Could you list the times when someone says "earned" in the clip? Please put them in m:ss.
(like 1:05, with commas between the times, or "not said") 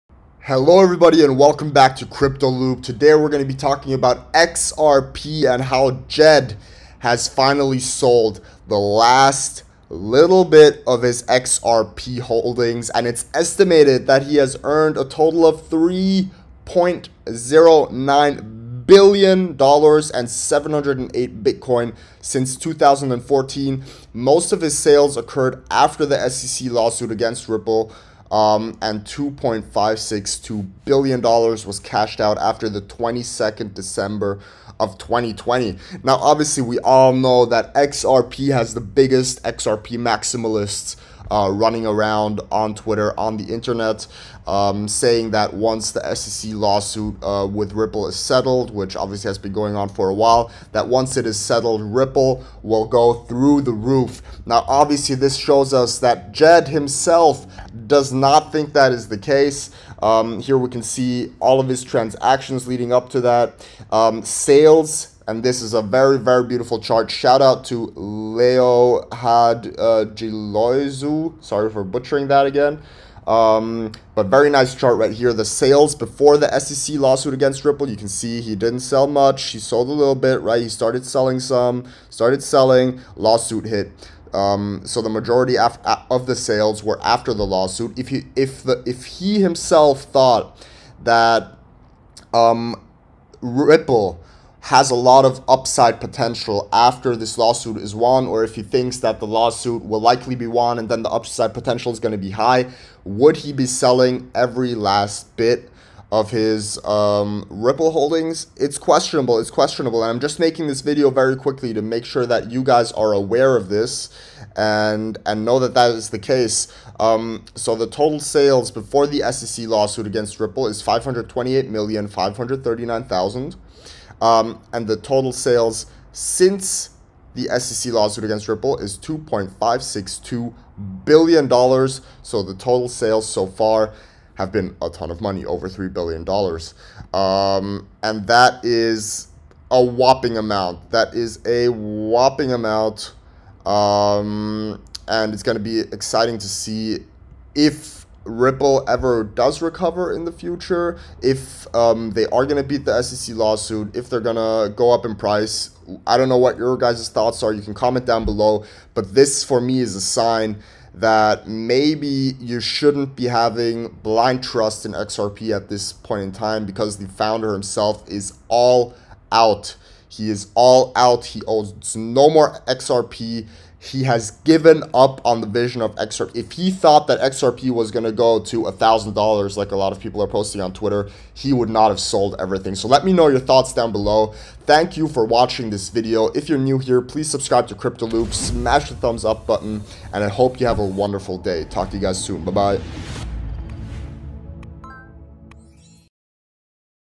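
0:14.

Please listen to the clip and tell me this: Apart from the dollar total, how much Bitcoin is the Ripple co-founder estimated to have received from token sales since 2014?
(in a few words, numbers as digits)
708 Bitcoin.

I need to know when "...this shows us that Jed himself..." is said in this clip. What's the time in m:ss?
0:55.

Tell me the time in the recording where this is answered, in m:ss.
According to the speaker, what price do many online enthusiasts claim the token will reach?
2:58.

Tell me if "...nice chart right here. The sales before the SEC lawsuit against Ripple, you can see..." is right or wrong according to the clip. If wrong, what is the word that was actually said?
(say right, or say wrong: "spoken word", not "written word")
right.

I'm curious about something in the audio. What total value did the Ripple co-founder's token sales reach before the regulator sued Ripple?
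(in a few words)
528,539,000.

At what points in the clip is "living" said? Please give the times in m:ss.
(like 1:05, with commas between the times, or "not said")
not said.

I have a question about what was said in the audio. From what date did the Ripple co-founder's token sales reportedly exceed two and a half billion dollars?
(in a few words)
22 December 2020.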